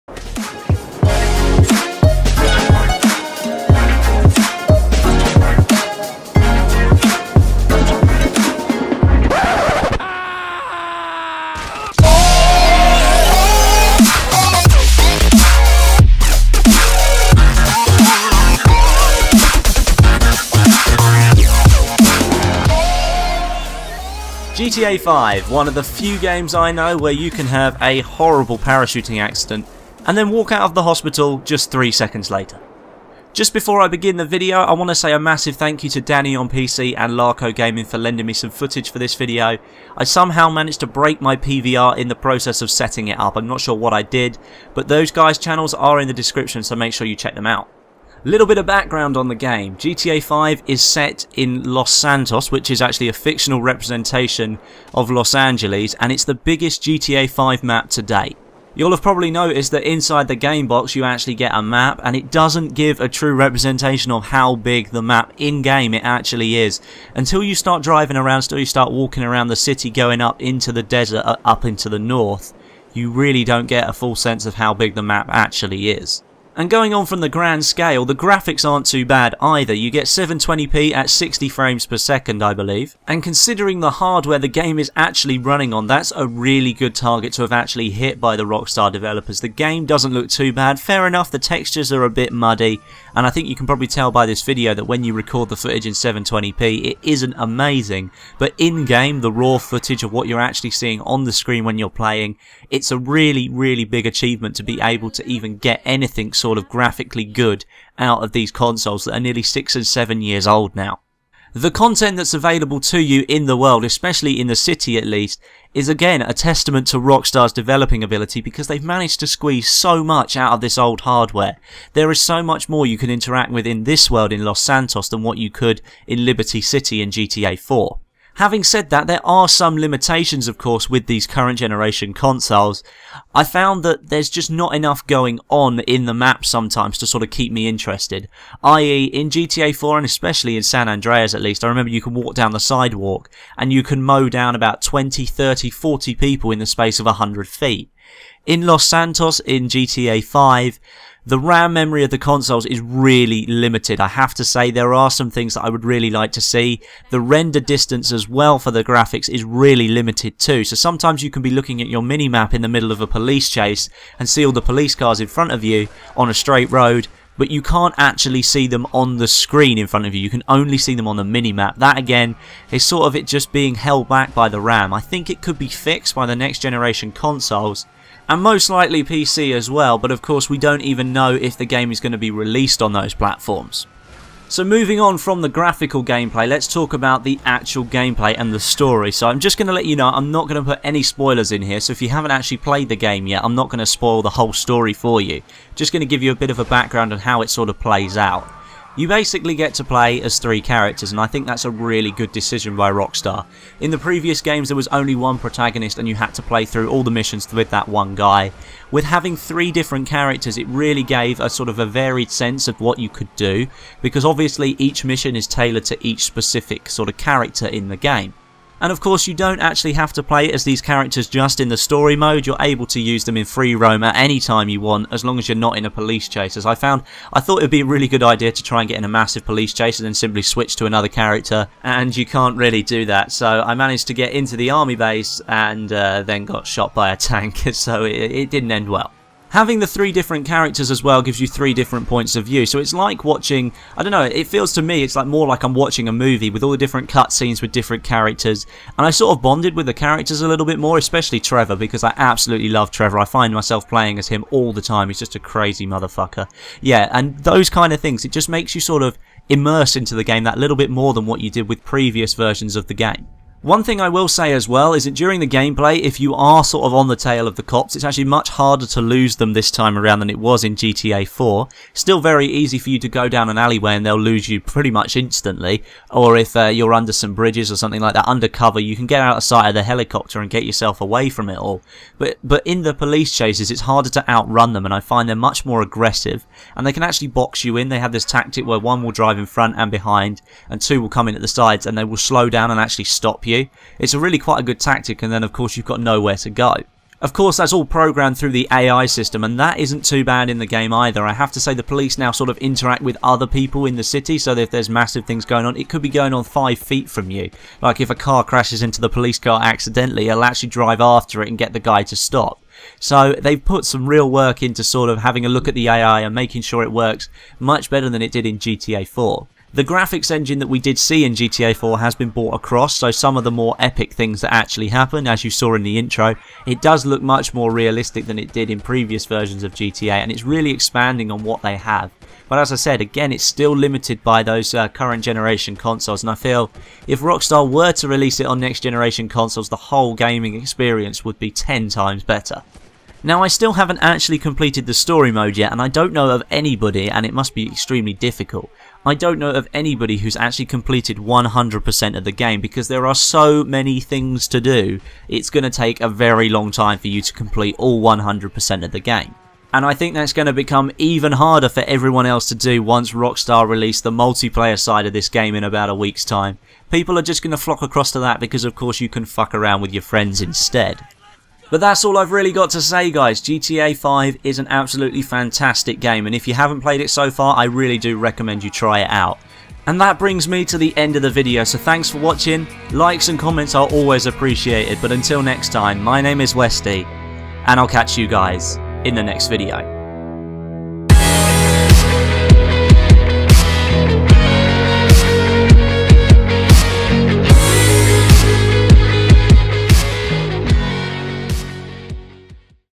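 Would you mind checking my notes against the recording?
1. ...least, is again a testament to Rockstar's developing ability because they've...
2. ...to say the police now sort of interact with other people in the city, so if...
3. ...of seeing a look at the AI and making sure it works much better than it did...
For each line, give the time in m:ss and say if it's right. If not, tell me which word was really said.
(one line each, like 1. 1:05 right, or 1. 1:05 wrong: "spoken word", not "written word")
1. 1:55 right
2. 5:01 right
3. 5:15 wrong: "having", not "seeing".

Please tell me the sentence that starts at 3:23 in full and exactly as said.
In the previous games, there was only one protagonist, and you had to play through all the missions with that one guy.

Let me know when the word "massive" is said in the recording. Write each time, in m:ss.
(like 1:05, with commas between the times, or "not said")
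0:35, 3:49, 5:04.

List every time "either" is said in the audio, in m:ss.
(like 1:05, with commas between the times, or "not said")
1:19, 5:00.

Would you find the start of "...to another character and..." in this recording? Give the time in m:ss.
3:50.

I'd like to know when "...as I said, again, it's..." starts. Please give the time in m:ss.
5:32.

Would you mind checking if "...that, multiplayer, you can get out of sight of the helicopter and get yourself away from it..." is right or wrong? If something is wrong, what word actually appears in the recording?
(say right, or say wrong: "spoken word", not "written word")
wrong: "undercover", not "multiplayer".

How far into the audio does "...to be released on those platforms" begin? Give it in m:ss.
3:02.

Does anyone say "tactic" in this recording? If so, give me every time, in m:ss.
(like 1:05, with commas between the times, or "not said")
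4:48, 4:54.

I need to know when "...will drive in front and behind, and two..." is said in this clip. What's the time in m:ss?
4:49.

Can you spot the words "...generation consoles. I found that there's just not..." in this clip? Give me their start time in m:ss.
2:11.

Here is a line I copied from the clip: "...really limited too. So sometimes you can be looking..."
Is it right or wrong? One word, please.
right.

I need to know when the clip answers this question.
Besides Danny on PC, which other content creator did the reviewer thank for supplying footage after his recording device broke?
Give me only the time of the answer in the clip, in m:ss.
0:37.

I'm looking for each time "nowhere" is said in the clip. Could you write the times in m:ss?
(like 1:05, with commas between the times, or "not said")
4:55.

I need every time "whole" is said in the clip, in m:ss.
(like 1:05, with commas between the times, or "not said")
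3:14, 5:39.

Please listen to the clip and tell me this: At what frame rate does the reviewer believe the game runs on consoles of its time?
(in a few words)
60 frames per second.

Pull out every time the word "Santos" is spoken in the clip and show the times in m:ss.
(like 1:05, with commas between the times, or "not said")
0:51, 2:04, 2:28.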